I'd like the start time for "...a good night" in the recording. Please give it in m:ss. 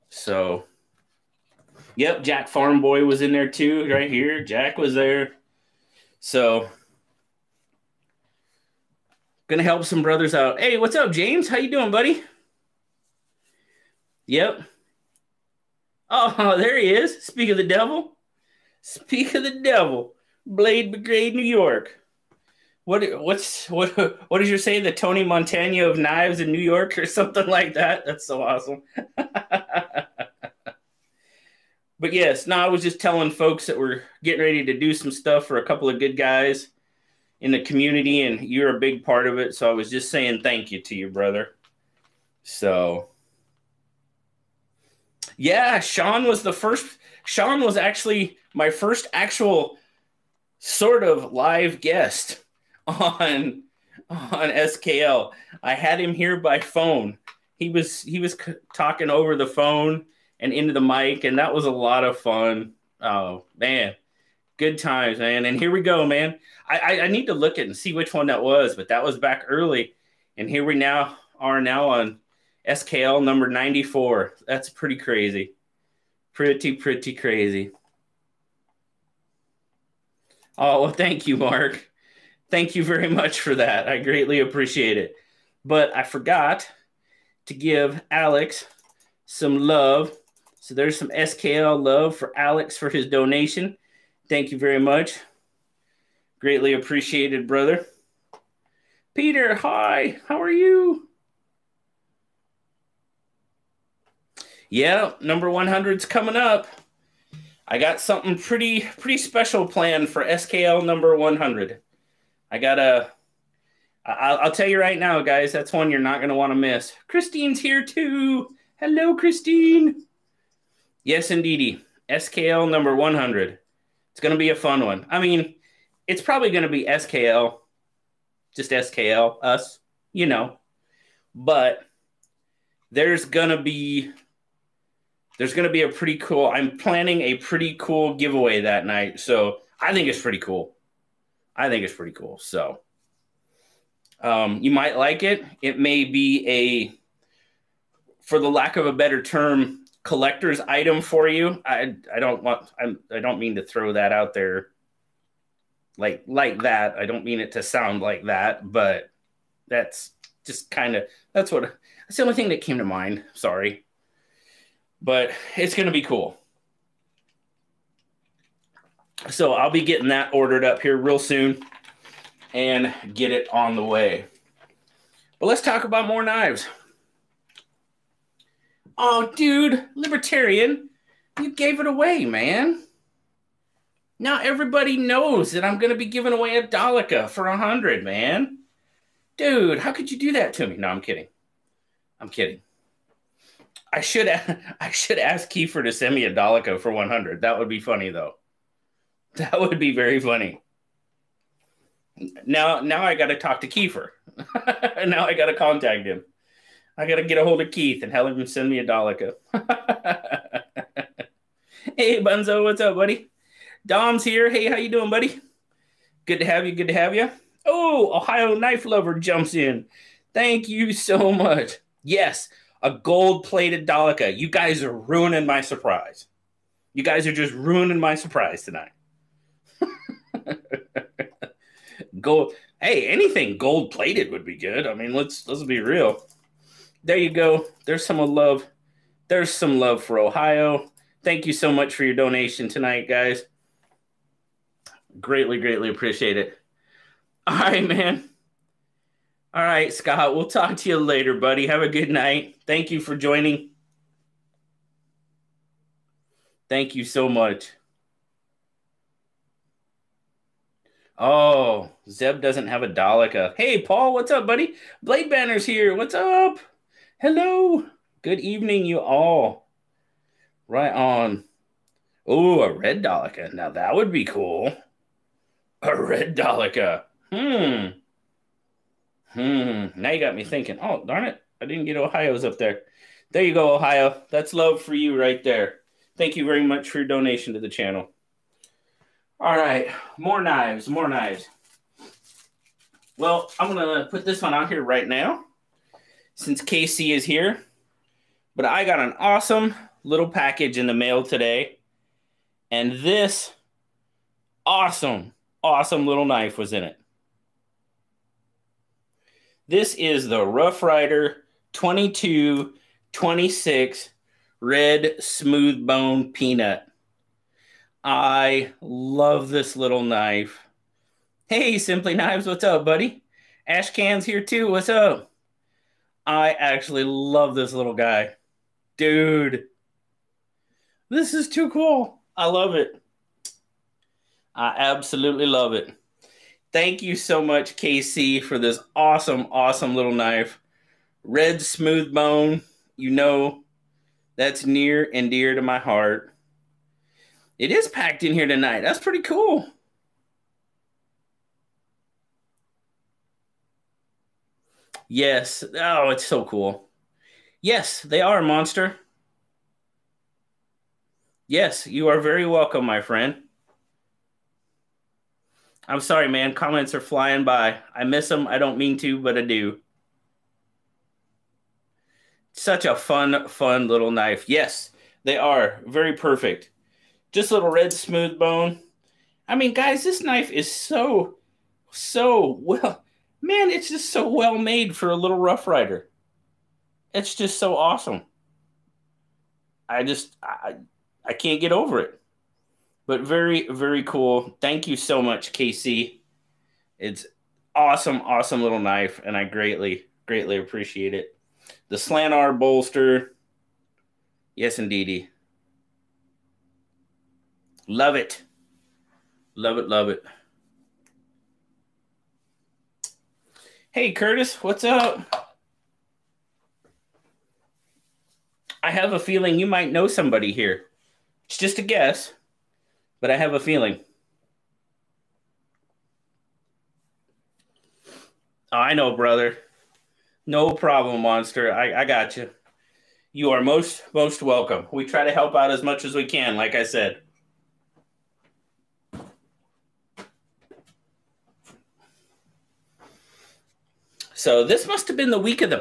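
4:11.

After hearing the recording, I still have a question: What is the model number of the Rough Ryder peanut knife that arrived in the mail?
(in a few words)
2226.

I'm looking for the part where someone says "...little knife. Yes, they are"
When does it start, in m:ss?
6:13.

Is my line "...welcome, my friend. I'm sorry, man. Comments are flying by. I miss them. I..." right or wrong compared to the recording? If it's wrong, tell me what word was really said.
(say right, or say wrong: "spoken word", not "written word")
right.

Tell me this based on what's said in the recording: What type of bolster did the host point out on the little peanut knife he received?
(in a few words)
Slanar.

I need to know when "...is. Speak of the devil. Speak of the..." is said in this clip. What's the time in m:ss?
0:16.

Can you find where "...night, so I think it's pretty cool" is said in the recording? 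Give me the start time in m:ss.
2:18.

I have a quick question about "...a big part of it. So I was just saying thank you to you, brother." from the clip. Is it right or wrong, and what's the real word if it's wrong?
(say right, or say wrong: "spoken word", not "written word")
right.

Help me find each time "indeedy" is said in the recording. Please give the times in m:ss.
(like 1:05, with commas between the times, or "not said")
2:01, 6:44.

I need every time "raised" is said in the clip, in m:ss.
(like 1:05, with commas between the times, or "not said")
not said.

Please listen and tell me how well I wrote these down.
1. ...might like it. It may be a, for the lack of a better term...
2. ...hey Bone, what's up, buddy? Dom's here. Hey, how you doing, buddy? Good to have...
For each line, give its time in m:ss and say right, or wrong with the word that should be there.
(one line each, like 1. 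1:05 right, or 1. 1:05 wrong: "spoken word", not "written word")
1. 2:24 right
2. 3:31 wrong: "Bunzo", not "Bone".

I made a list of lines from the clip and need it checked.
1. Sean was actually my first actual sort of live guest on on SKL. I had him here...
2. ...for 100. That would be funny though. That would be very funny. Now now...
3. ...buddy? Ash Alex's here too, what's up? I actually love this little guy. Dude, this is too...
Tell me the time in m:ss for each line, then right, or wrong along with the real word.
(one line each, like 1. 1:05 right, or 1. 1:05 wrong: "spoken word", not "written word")
1. 0:47 right
2. 3:16 right
3. 5:22 wrong: "Can", not "Alex".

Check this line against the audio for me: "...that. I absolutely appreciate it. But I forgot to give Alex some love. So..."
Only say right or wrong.
wrong.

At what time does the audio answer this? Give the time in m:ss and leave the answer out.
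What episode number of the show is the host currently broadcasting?
1:13.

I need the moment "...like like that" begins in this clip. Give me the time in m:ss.
2:35.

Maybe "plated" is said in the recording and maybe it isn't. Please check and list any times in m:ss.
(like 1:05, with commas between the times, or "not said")
3:43, 3:53.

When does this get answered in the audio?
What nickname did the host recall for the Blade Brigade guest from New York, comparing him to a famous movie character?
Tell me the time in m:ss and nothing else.
0:24.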